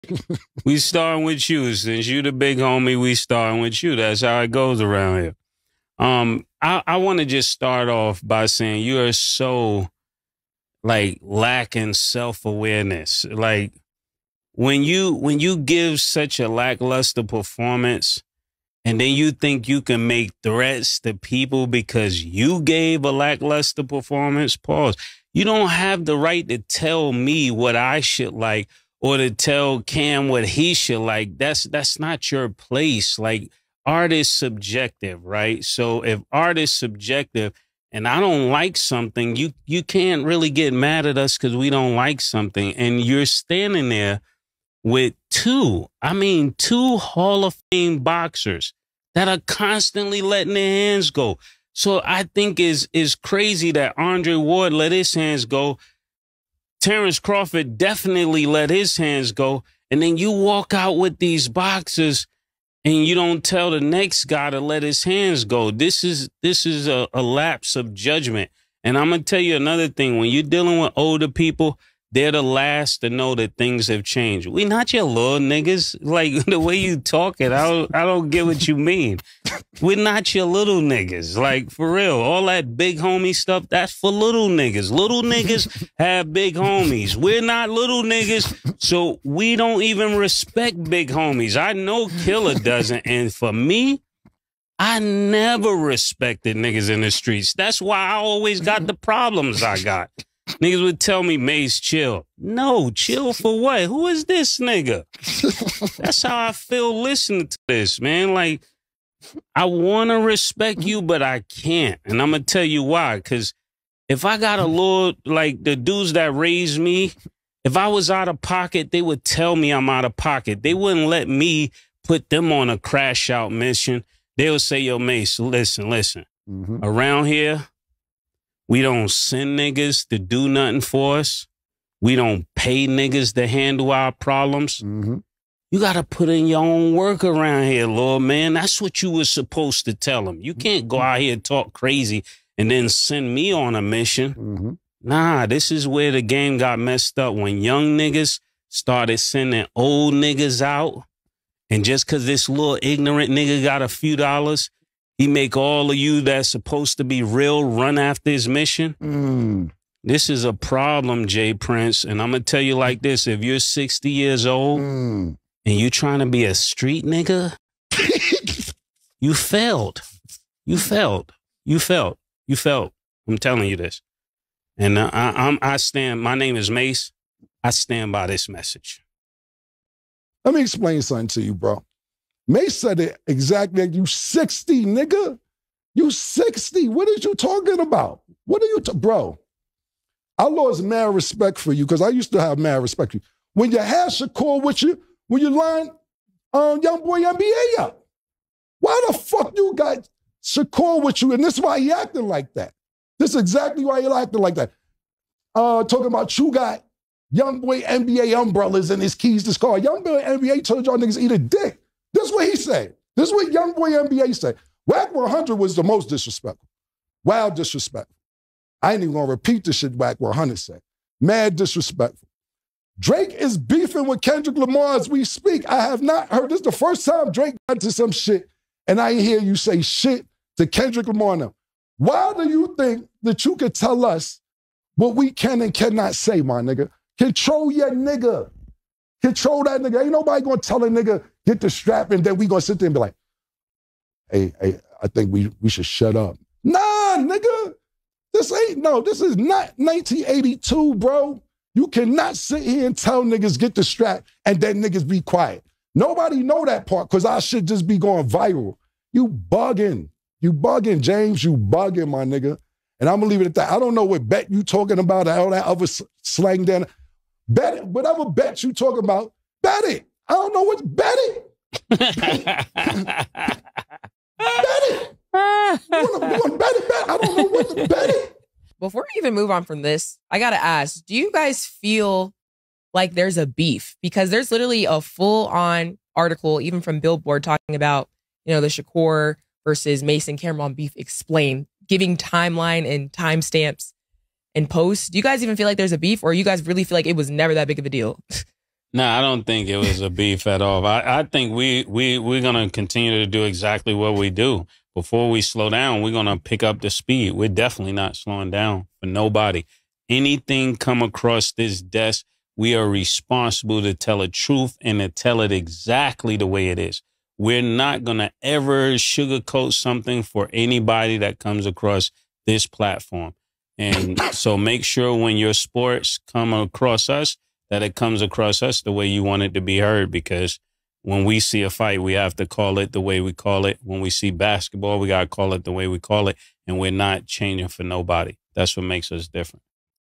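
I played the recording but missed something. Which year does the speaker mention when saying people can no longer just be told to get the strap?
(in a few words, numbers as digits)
1982.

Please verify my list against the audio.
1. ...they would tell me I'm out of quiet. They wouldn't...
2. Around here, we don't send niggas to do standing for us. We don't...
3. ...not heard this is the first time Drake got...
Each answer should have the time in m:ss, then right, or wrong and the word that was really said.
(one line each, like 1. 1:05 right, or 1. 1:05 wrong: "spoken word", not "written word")
1. 1:58 wrong: "pocket", not "quiet"
2. 2:06 wrong: "nothing", not "standing"
3. 3:46 right.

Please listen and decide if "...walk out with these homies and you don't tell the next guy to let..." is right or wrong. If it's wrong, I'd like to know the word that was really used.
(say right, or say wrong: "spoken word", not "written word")
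wrong: "boxes", not "homies".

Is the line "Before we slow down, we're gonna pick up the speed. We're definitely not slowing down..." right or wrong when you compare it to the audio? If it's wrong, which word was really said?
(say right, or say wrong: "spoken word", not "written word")
right.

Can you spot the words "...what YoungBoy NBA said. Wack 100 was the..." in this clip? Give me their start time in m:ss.
3:33.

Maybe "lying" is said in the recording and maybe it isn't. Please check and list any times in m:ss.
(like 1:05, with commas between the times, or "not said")
3:15.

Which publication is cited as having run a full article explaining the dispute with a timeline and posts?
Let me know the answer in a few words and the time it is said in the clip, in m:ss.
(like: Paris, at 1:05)
Billboard, at 4:46.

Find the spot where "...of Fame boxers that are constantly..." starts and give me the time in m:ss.
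0:47.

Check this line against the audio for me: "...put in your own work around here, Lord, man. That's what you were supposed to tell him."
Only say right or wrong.
right.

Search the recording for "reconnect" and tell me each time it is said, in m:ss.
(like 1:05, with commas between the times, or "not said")
not said.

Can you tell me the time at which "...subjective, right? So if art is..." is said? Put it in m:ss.
0:34.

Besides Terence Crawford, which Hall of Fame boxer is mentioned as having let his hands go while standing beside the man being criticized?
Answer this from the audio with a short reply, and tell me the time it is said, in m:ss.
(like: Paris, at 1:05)
Andre Ward, at 0:53.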